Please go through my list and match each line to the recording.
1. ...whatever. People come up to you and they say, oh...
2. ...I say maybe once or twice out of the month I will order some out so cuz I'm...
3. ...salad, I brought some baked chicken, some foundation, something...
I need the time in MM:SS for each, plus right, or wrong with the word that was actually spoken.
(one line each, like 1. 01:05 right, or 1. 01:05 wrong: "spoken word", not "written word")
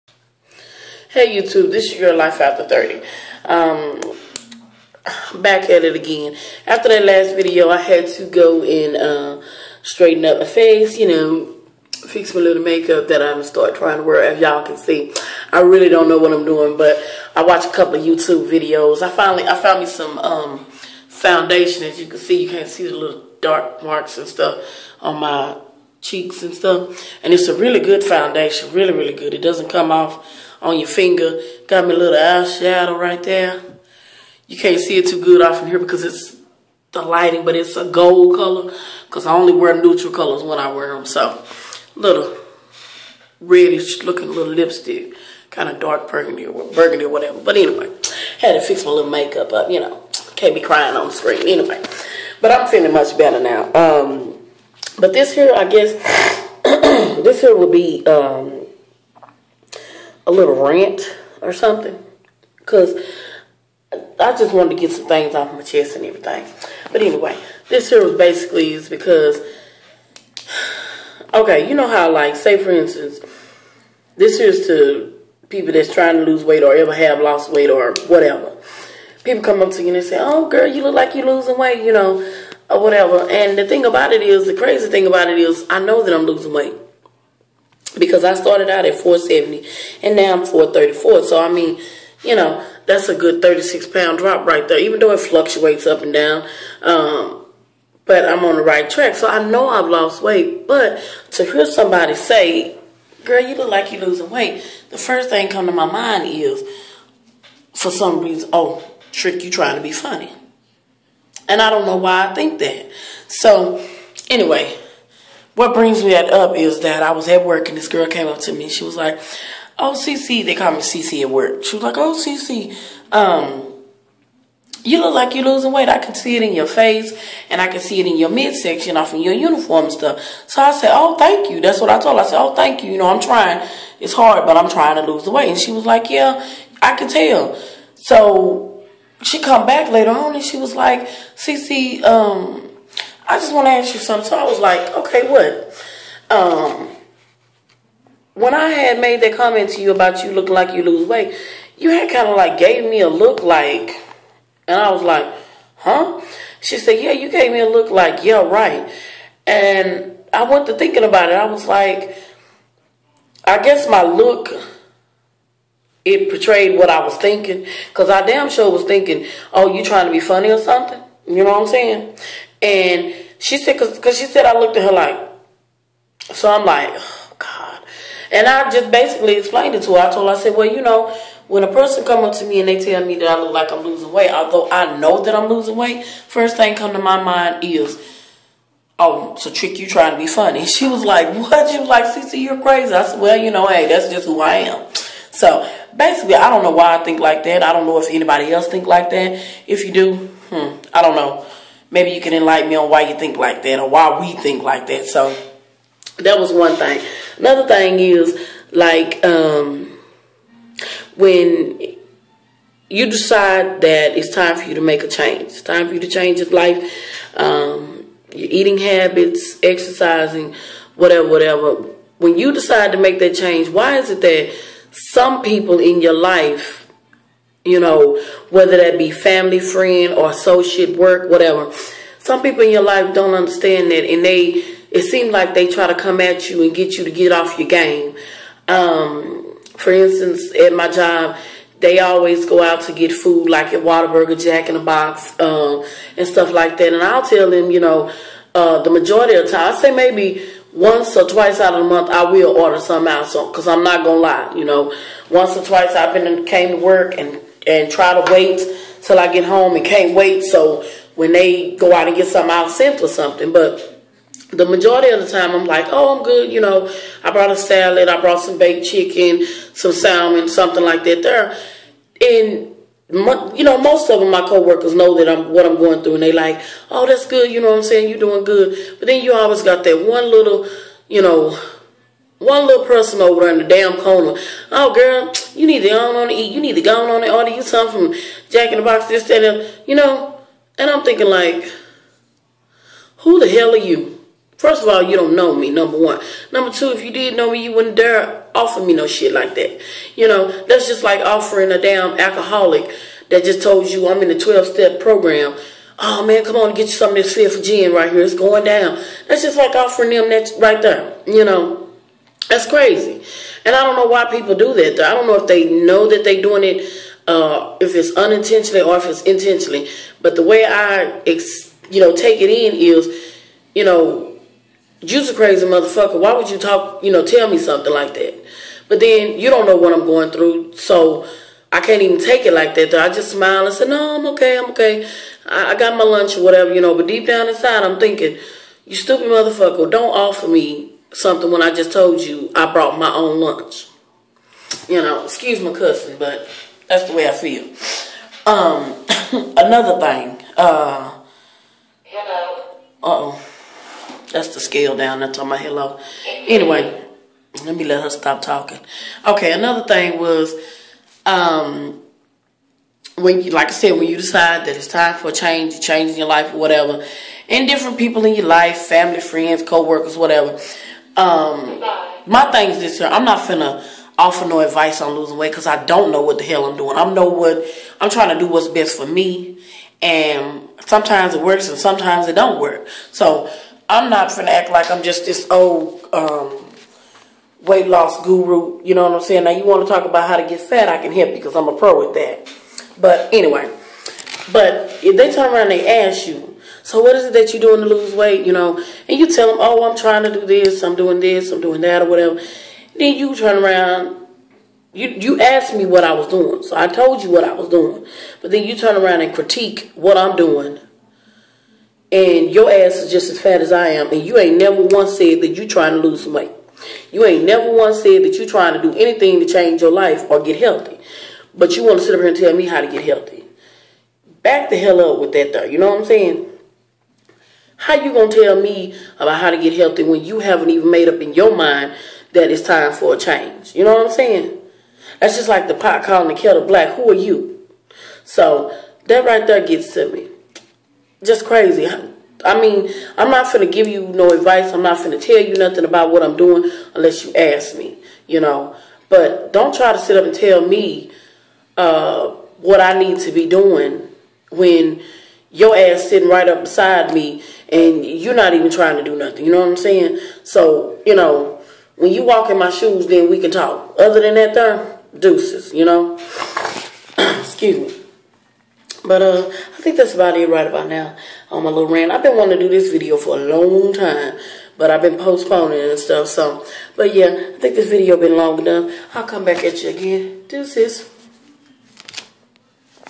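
1. 01:18 right
2. 04:09 right
3. 04:27 wrong: "salmon", not "foundation".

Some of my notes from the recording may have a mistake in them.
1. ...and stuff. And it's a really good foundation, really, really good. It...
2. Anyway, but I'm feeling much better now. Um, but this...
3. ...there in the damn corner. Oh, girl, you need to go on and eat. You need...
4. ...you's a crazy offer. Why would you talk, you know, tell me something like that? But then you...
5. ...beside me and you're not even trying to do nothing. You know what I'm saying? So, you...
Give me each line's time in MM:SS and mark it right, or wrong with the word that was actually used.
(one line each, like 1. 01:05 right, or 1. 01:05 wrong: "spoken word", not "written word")
1. 00:26 right
2. 00:51 right
3. 04:43 right
4. 05:25 wrong: "motherfucker", not "offer"
5. 07:36 right.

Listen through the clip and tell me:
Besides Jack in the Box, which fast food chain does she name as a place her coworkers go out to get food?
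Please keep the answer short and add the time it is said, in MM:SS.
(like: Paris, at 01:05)
Whataburger, at 04:03.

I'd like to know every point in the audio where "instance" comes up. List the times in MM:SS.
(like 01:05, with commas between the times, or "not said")
01:12, 03:59.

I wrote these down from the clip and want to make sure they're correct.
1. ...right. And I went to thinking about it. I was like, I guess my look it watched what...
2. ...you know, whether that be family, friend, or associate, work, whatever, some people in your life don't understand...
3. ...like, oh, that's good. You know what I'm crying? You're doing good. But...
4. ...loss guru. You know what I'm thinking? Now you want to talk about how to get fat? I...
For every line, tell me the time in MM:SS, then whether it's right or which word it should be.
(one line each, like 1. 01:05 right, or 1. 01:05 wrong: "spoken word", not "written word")
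1. 02:38 wrong: "portrayed", not "watched"
2. 03:47 right
3. 04:36 wrong: "saying", not "crying"
4. 06:27 wrong: "saying", not "thinking".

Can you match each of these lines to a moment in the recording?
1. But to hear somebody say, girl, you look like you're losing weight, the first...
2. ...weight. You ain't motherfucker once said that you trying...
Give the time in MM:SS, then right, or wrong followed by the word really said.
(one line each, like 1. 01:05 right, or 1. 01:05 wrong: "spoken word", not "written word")
1. 01:40 right
2. 06:56 wrong: "never", not "motherfucker".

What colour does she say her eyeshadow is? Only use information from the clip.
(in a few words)
gold.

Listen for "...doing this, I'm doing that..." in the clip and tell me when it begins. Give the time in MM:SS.
06:40.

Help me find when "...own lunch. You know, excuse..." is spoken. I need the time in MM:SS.
05:43.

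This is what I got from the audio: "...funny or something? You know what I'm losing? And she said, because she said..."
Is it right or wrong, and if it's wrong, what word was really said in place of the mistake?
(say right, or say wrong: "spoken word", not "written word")
wrong: "saying", not "losing".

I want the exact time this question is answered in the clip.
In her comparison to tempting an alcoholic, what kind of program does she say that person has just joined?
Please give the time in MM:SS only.
05:04.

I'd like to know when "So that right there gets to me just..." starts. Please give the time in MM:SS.
07:18.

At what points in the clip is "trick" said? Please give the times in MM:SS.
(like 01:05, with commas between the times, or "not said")
01:49, 03:09.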